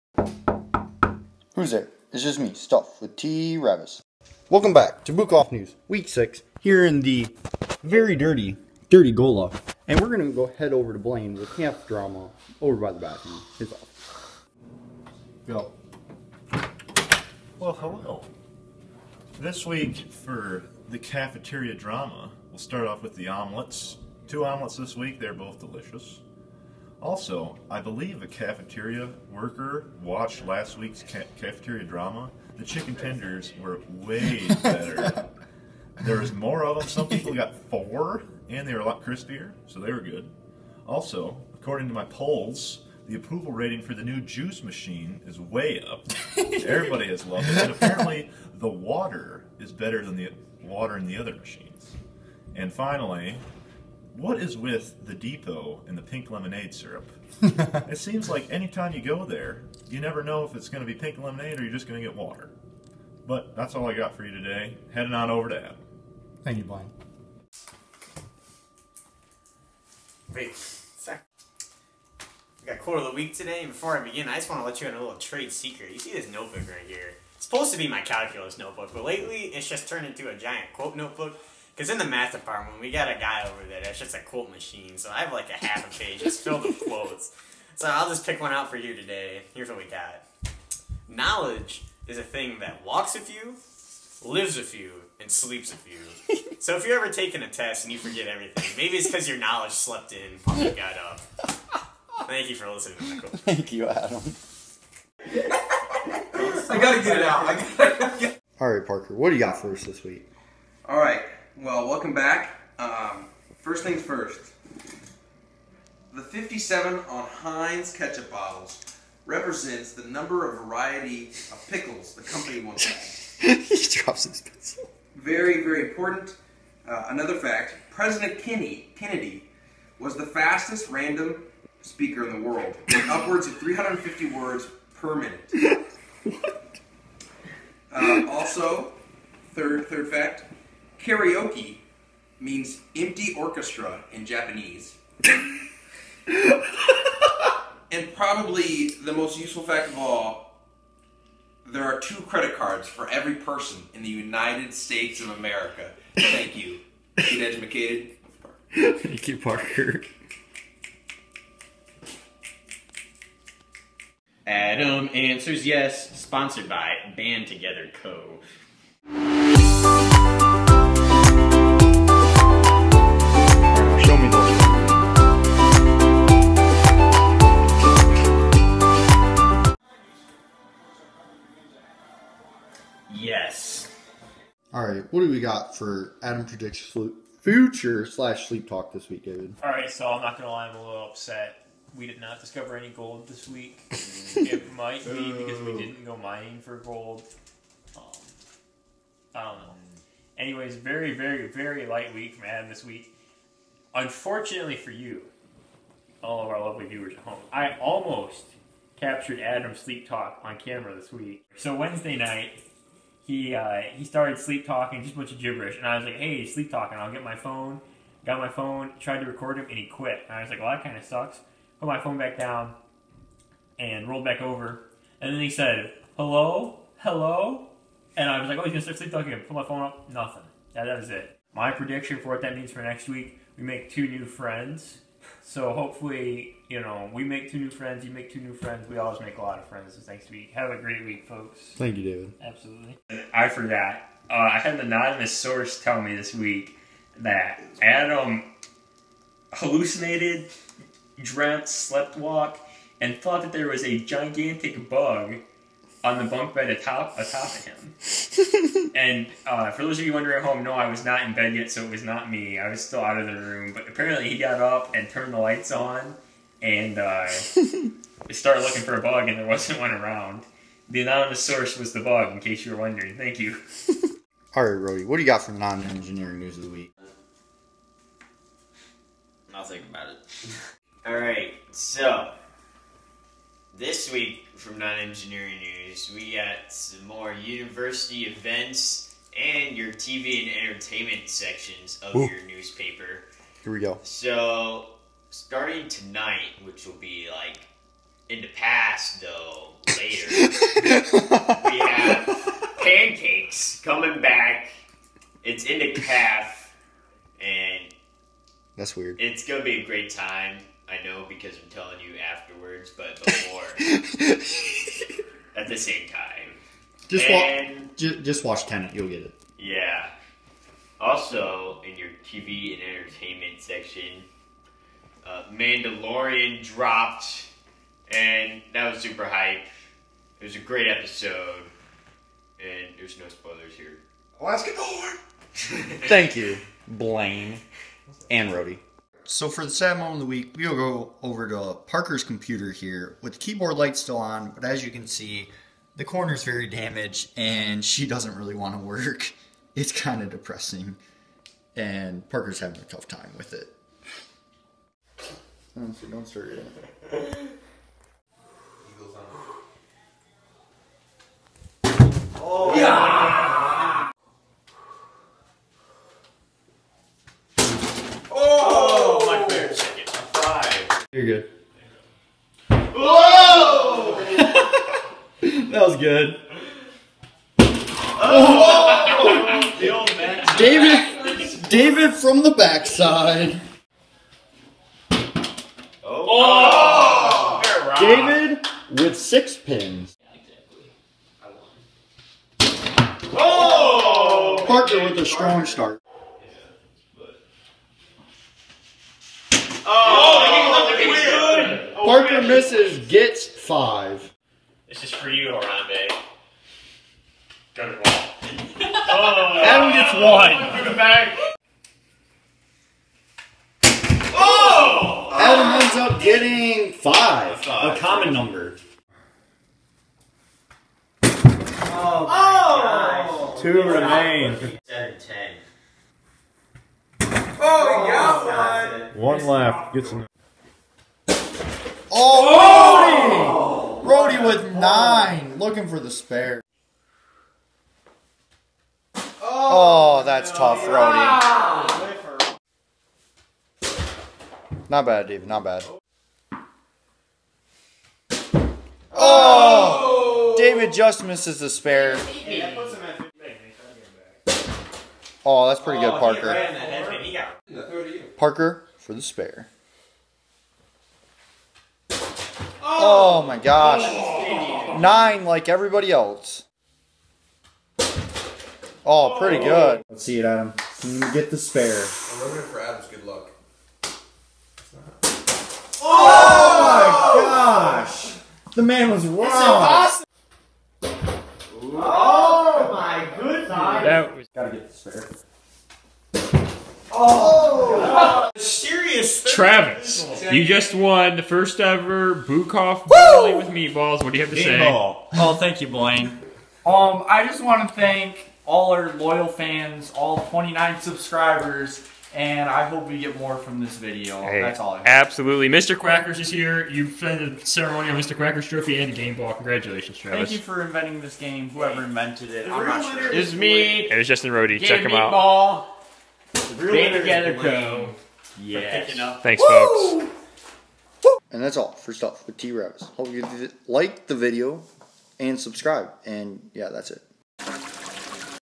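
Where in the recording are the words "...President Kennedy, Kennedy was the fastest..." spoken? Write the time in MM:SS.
02:07.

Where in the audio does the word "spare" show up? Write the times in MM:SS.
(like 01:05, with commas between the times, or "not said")
07:16, 07:31, 07:39, 07:51, 08:06.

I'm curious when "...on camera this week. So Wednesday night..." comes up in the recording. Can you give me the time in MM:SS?
03:30.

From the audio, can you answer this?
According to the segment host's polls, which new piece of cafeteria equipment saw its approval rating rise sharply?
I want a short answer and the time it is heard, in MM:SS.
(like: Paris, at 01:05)
juice machine, at 00:44.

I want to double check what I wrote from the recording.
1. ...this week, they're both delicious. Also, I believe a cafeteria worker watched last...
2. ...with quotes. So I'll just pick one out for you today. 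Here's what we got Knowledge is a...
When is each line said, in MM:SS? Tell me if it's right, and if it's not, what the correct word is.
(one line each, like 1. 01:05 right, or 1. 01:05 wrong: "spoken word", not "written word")
1. 00:24 right
2. 01:26 right.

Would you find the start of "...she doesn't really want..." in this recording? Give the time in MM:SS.
05:47.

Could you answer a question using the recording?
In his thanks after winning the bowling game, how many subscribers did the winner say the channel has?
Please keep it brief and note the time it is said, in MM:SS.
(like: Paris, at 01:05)
29, at 08:20.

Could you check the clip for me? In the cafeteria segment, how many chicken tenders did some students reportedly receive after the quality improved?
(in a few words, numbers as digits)
4.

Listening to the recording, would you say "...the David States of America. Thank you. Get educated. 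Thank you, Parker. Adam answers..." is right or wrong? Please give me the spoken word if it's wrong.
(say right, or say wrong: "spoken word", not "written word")
wrong: "United", not "David".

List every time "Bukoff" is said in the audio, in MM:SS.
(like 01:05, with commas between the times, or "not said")
00:05, 08:12.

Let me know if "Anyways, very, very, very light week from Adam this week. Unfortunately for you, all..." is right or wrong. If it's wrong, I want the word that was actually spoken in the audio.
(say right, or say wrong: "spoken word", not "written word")
right.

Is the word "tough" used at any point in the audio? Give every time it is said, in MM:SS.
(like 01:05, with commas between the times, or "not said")
05:52, 07:20.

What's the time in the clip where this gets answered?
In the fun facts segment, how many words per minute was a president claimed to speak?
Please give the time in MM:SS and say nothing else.
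02:13.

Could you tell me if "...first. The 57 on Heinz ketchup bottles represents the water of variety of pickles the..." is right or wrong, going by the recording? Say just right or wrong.
wrong.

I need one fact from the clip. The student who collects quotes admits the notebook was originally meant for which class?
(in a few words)
calculus.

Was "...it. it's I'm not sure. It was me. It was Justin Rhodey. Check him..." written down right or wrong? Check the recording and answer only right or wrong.
right.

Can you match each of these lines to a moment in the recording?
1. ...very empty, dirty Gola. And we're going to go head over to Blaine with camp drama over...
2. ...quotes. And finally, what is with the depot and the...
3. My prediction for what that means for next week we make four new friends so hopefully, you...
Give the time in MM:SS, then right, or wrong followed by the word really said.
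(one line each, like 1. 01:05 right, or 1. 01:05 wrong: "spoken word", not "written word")
1. 00:07 wrong: "dirty", not "empty"
2. 00:51 wrong: "machines", not "quotes"
3. 03:51 wrong: "two", not "four".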